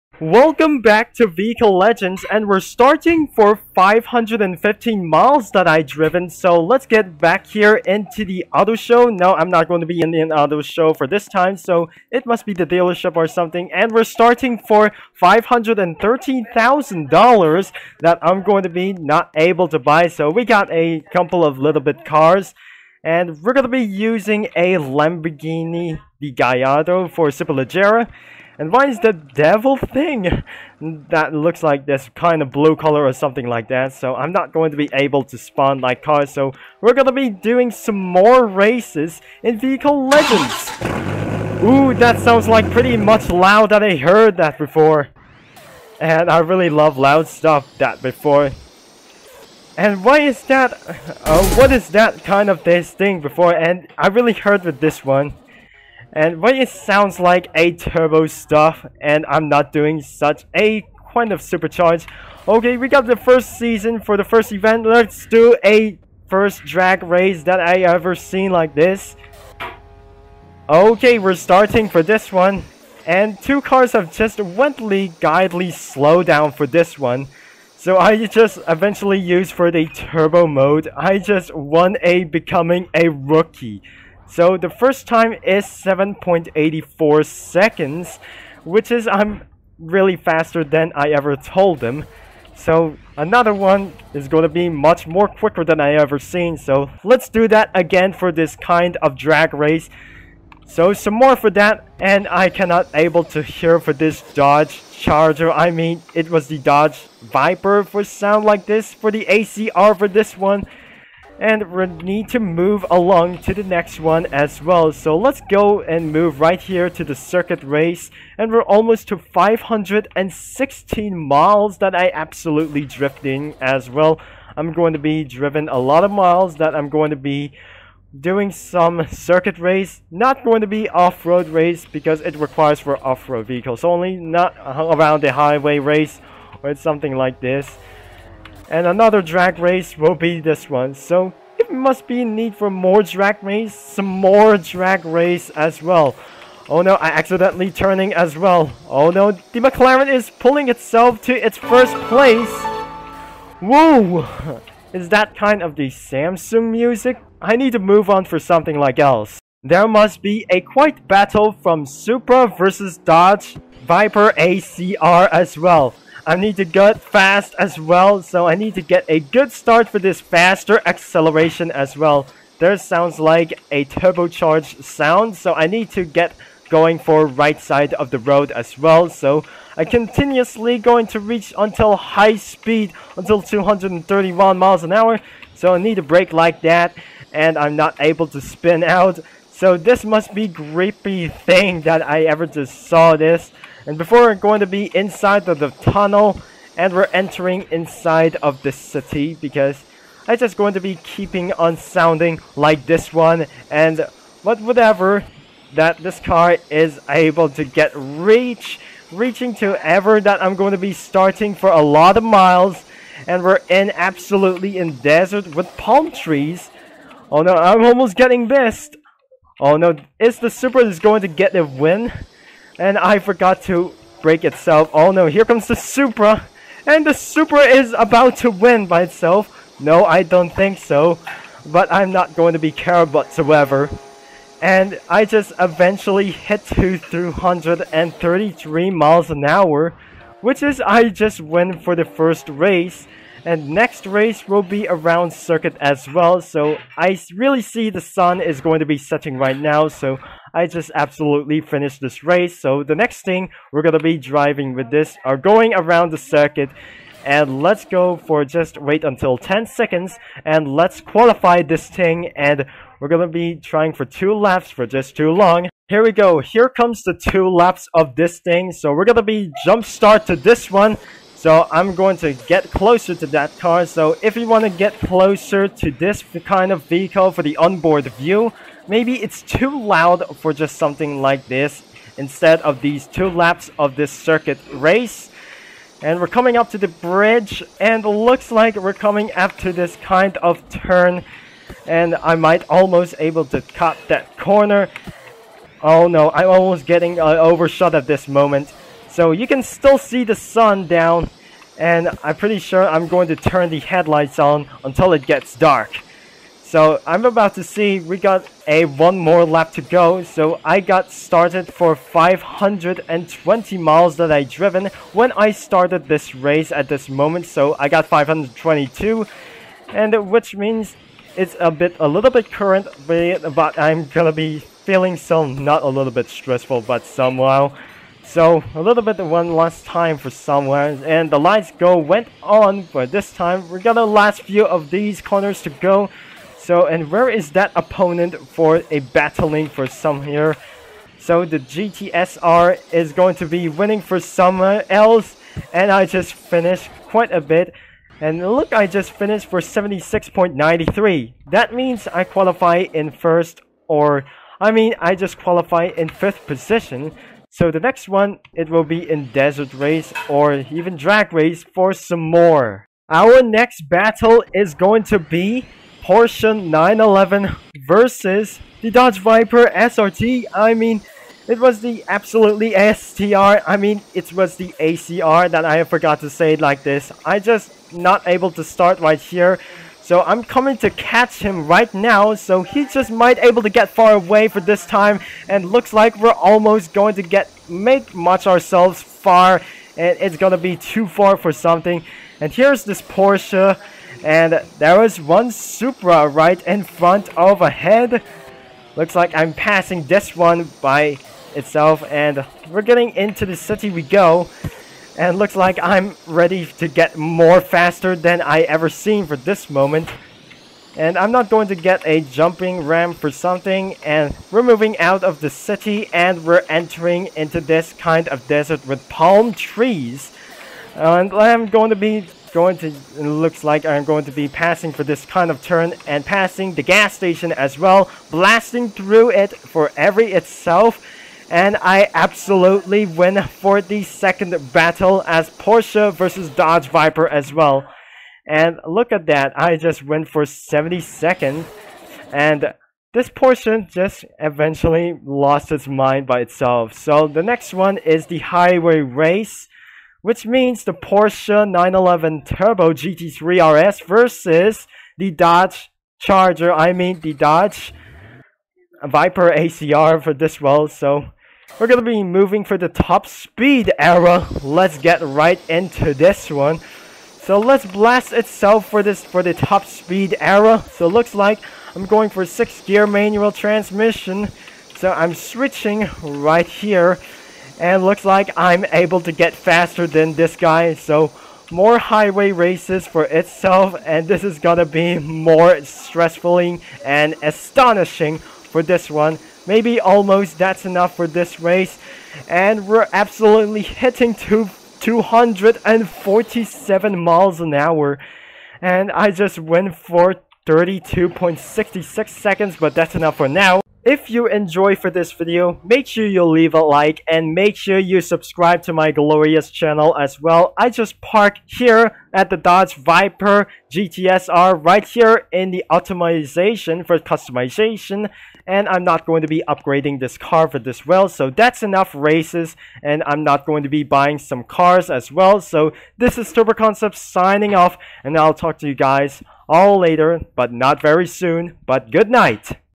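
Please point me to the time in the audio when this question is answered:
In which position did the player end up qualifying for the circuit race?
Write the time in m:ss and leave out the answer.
5:56.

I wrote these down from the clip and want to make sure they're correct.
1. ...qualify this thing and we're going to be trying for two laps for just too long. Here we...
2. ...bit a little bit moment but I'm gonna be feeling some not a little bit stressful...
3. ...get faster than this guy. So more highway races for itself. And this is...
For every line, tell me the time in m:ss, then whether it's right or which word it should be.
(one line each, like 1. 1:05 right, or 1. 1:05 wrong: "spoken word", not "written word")
1. 4:21 right
2. 5:21 wrong: "current", not "moment"
3. 7:59 right.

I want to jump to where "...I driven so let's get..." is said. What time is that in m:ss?
0:05.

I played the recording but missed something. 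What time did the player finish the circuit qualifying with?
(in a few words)
76.93.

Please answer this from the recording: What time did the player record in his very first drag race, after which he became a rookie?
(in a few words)
7.84 seconds.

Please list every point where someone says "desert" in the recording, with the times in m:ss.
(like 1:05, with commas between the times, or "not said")
3:35, 5:59, 6:58.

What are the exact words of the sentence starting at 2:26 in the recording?
Oh no, I accidentally turning as well.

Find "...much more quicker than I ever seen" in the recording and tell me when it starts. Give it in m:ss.
1:34.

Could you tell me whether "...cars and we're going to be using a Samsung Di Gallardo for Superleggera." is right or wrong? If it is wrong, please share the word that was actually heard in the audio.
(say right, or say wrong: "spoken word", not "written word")
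wrong: "Lamborghini", not "Samsung".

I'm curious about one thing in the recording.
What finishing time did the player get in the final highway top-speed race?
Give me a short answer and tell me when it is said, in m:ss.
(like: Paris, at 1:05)
32.66 seconds, at 8:20.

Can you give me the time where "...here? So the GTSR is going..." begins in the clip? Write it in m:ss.
5:40.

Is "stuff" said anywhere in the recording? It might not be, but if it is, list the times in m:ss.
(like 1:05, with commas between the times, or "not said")
0:47, 0:58.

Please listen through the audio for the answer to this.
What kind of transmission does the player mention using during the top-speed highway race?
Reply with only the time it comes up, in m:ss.
7:52.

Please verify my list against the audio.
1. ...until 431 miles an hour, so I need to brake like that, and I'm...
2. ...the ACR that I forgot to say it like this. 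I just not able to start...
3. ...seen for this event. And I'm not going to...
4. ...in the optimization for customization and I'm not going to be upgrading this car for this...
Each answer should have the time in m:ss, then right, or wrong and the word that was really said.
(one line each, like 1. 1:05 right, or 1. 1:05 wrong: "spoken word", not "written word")
1. 3:03 wrong: "231", not "431"
2. 6:14 right
3. 6:48 wrong: "moment", not "event"
4. 8:35 right.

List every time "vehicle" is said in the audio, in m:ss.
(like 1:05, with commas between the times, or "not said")
0:01, 0:39, 2:13, 4:36.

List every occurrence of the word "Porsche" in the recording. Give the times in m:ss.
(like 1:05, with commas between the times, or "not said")
6:06, 6:33, 7:15, 7:23, 7:30.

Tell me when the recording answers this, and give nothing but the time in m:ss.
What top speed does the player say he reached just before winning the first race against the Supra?
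3:56.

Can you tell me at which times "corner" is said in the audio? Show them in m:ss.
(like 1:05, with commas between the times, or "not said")
4:54, 5:35.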